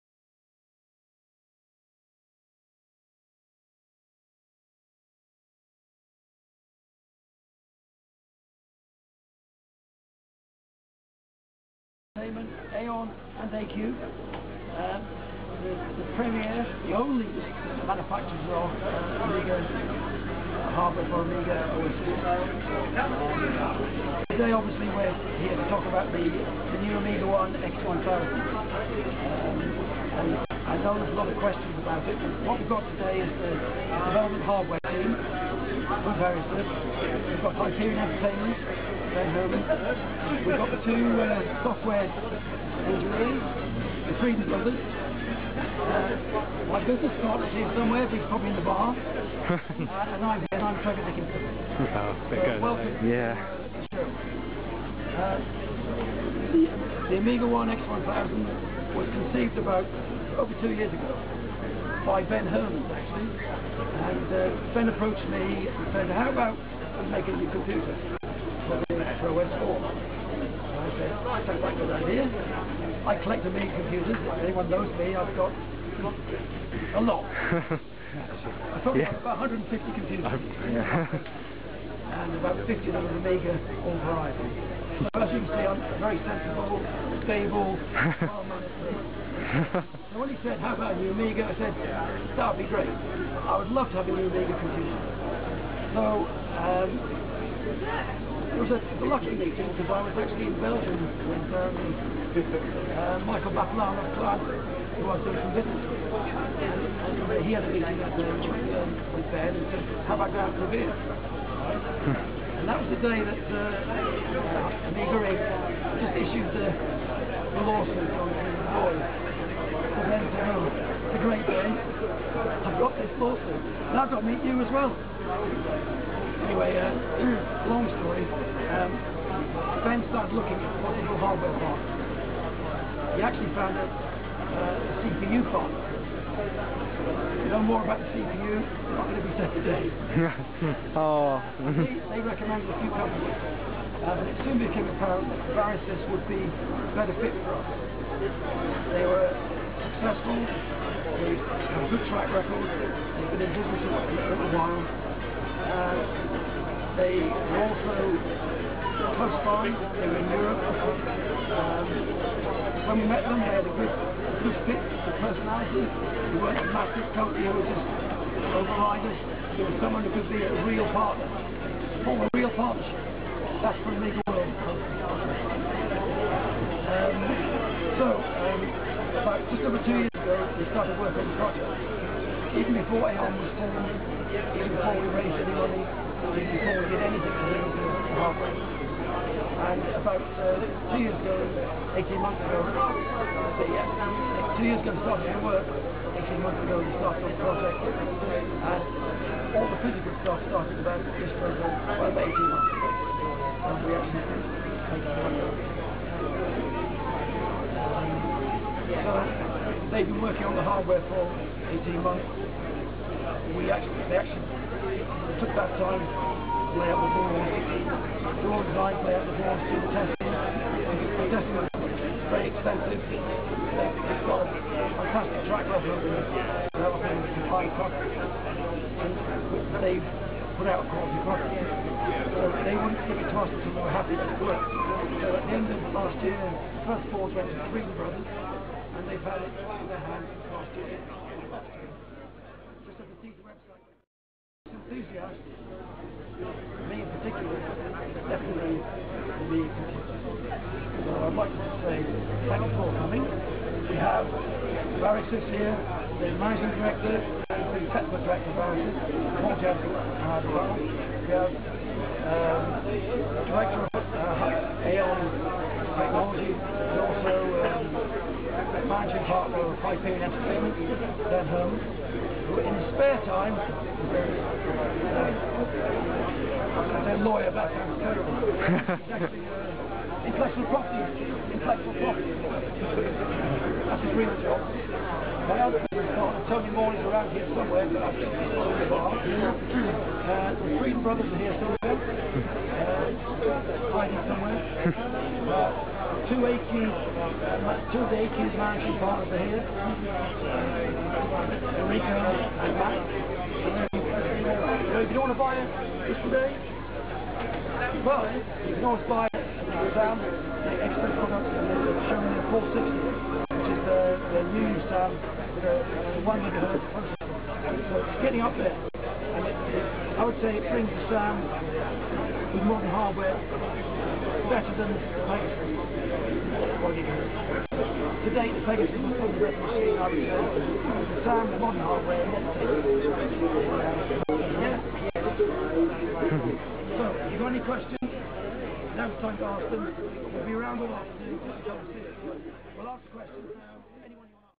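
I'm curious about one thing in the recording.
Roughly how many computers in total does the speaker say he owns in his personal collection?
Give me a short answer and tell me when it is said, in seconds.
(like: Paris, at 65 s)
150, at 79 s.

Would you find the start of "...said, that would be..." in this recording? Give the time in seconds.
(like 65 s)
91 s.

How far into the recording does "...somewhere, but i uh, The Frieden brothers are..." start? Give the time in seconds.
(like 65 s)
287 s.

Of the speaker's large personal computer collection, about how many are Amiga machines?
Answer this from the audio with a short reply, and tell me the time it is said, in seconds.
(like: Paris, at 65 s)
50, at 82 s.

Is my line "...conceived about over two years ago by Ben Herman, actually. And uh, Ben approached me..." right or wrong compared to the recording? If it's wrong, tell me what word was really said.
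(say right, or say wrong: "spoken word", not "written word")
right.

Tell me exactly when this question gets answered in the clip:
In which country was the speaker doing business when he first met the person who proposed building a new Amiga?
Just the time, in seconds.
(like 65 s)
100 s.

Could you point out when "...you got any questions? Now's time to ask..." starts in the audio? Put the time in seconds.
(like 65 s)
337 s.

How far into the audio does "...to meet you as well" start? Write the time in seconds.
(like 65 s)
124 s.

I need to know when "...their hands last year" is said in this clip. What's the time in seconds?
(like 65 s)
239 s.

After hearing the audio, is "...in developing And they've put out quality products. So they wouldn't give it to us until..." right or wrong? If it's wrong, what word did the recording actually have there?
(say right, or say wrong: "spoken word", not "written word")
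right.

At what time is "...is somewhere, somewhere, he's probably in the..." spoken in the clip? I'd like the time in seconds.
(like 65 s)
47 s.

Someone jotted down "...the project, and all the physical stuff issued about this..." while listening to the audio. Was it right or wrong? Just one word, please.
wrong.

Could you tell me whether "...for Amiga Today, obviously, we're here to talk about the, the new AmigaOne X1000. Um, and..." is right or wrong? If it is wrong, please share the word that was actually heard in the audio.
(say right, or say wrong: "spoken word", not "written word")
right.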